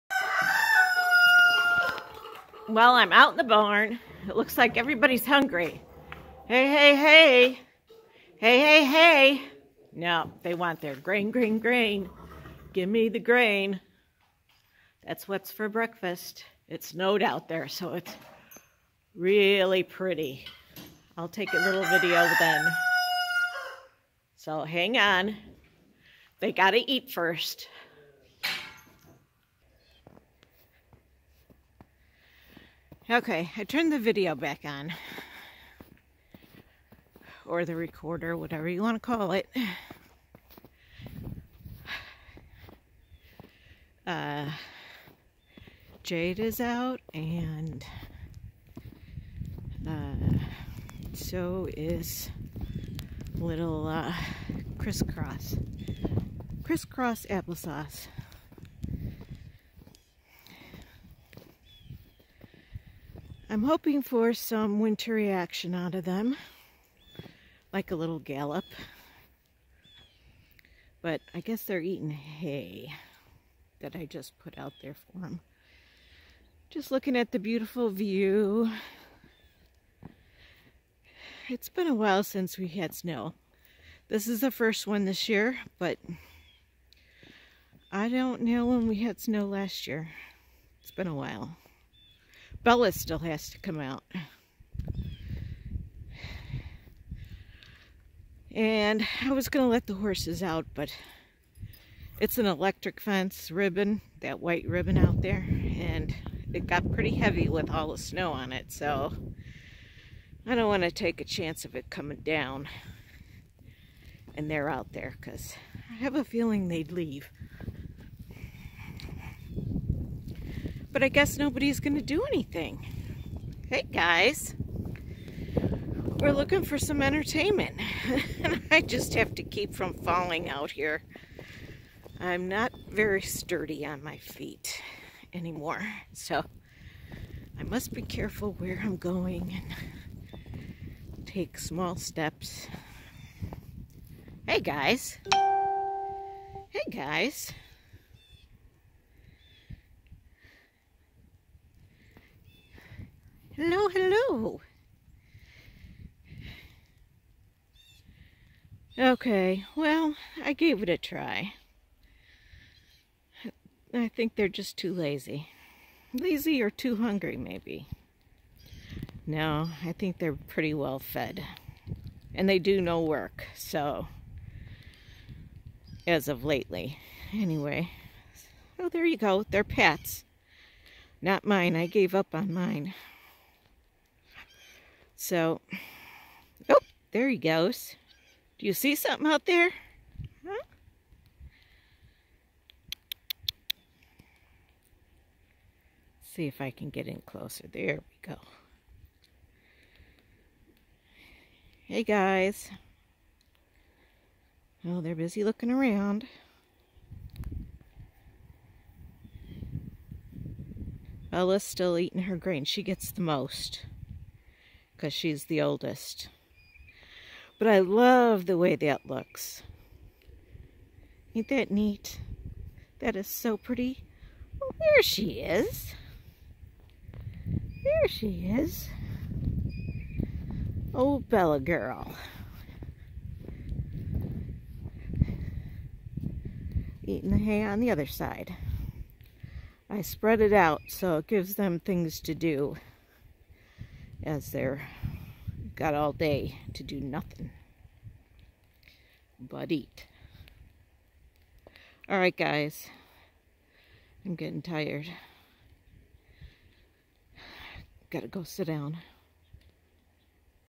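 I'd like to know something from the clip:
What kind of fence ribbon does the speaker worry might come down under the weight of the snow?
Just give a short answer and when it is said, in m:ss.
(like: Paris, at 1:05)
Electric fence ribbon, at 1:42.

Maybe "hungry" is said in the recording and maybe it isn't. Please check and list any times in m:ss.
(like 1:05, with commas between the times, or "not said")
0:05, 2:46.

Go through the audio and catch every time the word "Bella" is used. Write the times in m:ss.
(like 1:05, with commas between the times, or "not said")
1:32, 3:31, 3:51.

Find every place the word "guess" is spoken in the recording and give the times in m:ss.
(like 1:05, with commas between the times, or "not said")
1:11, 2:01.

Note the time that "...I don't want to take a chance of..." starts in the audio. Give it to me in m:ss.
1:50.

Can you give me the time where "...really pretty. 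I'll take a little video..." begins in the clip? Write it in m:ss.
0:19.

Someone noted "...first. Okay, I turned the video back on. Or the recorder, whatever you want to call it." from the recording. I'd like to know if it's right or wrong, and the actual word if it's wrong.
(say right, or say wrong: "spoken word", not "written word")
right.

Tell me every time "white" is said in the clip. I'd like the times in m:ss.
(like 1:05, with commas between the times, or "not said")
1:44.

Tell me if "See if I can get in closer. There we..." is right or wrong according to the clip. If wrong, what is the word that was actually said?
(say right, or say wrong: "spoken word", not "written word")
right.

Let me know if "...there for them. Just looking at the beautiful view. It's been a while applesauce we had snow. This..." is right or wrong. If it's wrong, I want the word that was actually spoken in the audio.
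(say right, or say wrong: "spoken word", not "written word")
wrong: "since", not "applesauce".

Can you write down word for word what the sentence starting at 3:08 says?
Do you see something out there?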